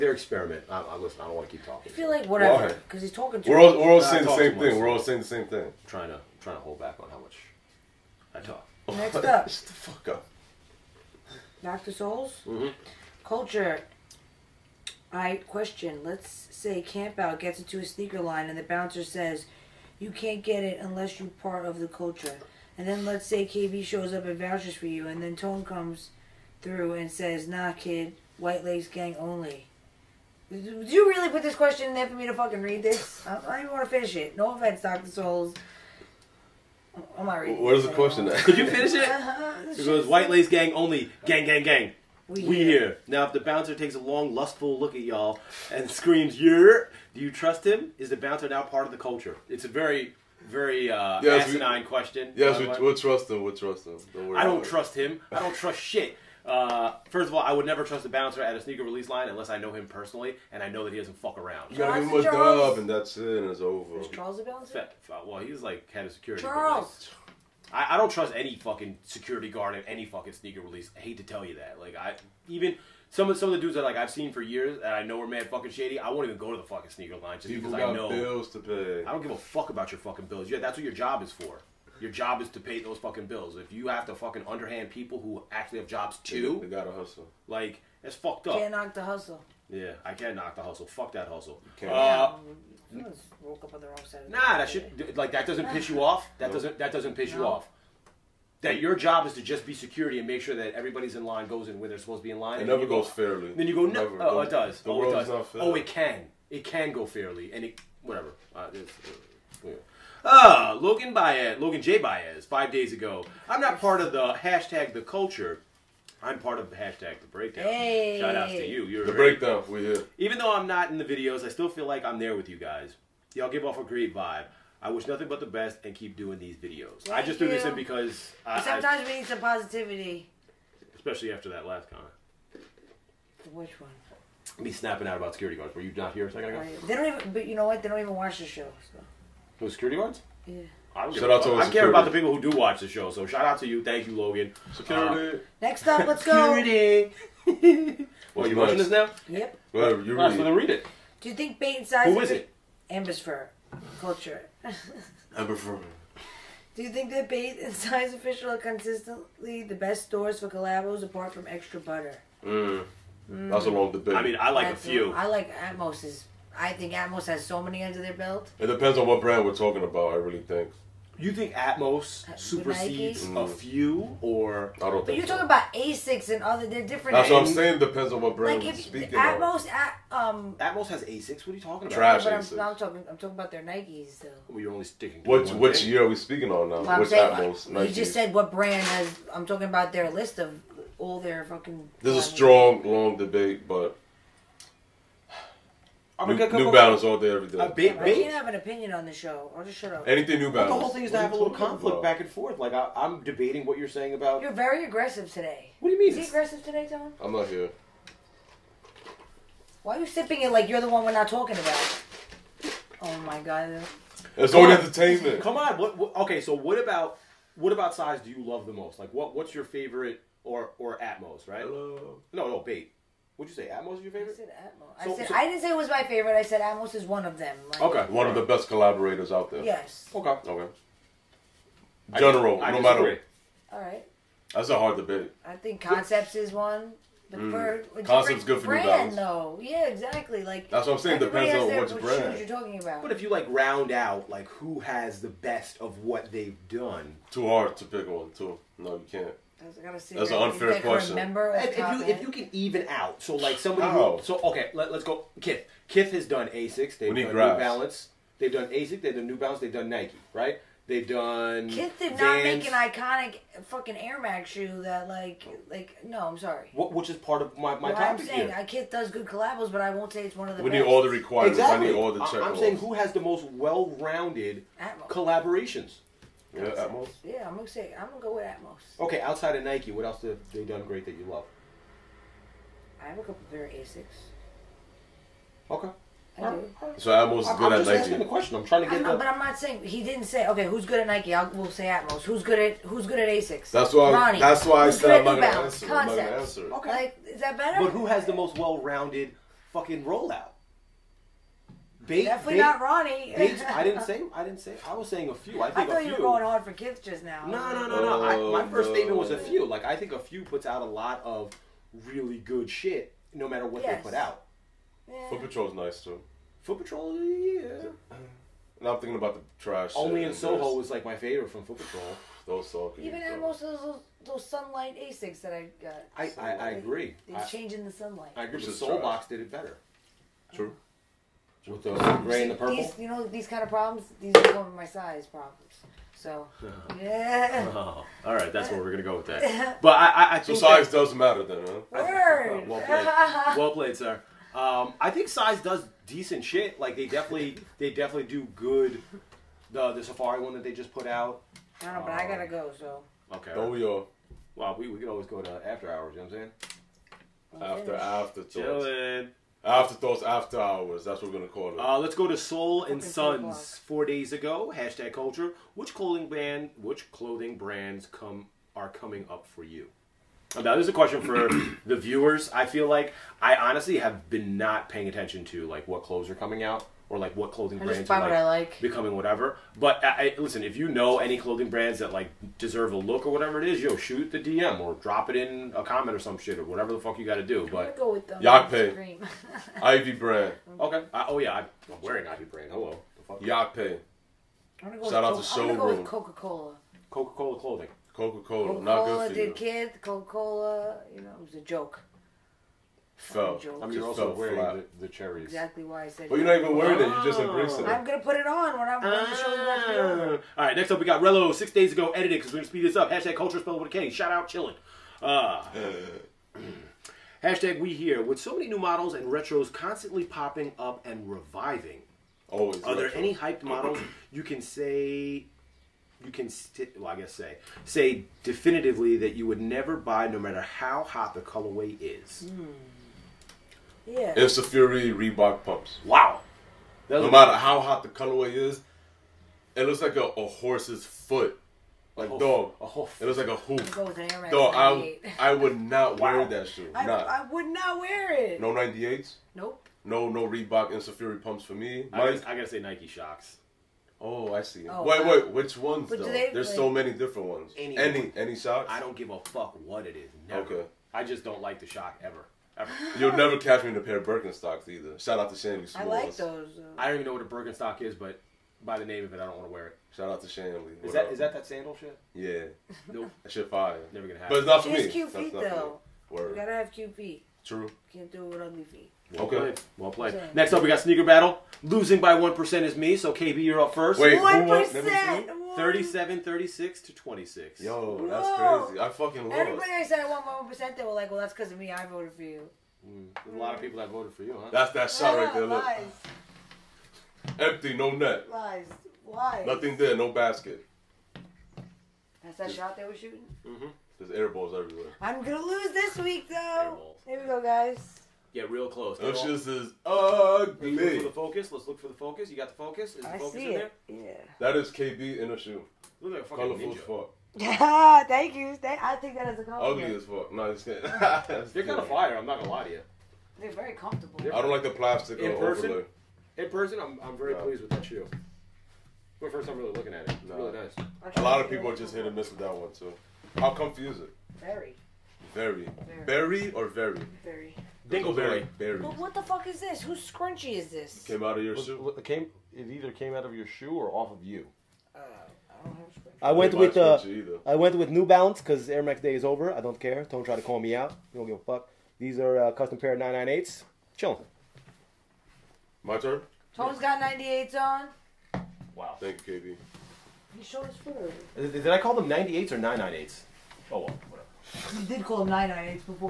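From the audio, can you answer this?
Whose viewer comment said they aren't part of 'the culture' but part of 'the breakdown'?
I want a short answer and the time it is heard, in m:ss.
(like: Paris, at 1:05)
Logan J. Baez, at 1:51.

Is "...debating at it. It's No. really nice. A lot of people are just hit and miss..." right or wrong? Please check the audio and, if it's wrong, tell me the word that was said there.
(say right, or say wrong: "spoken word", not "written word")
wrong: "looking", not "debating".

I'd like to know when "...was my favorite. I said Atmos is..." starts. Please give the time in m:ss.
3:45.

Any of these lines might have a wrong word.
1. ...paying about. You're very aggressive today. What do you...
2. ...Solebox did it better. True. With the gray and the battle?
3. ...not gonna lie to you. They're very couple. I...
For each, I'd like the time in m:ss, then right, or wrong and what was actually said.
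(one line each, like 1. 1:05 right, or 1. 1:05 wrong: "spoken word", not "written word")
1. 3:23 wrong: "saying", not "paying"
2. 5:28 wrong: "purple", not "battle"
3. 8:42 wrong: "comfortable", not "couple".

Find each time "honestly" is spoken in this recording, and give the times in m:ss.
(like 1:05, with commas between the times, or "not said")
6:13.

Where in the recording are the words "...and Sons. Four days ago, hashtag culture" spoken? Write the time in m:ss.
6:02.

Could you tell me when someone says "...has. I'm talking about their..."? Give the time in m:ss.
3:08.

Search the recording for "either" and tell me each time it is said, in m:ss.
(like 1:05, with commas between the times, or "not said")
7:44, 9:02.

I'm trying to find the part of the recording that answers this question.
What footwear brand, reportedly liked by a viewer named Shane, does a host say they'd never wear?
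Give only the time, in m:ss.
7:44.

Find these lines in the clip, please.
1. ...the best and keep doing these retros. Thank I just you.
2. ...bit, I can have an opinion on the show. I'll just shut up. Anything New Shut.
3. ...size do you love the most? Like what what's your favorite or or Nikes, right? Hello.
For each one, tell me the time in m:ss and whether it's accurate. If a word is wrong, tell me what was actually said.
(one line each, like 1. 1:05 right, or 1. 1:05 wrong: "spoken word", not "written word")
1. 2:05 wrong: "videos", not "retros"
2. 3:17 wrong: "Balance", not "Shut"
3. 3:37 wrong: "Atmos", not "Nikes".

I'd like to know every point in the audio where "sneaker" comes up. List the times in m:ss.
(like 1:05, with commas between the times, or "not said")
0:17, 0:58, 1:10, 1:16, 8:00.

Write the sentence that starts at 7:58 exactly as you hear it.
Can't do it with ugly feet.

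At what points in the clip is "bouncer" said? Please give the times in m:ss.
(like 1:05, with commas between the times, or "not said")
0:18, 0:43, 0:48, 0:58, 1:04.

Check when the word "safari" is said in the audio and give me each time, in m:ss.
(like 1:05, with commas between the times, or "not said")
5:50, 7:31.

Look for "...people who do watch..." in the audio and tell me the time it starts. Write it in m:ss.
2:22.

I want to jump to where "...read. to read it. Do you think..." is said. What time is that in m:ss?
2:30.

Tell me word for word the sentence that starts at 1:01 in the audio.
You gotta give him a dub, and that's it, and it's over.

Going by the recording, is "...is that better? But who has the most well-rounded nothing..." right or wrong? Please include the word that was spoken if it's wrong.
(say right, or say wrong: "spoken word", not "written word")
wrong: "fucking", not "nothing".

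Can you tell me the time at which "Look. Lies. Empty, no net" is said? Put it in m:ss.
8:15.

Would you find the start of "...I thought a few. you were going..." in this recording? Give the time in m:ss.
5:05.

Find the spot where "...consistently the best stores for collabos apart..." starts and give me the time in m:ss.
2:38.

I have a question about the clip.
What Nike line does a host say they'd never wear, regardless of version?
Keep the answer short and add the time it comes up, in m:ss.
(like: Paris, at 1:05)
Nike Shox, at 7:32.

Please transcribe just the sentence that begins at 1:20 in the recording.
Yeah, that's what your job is for.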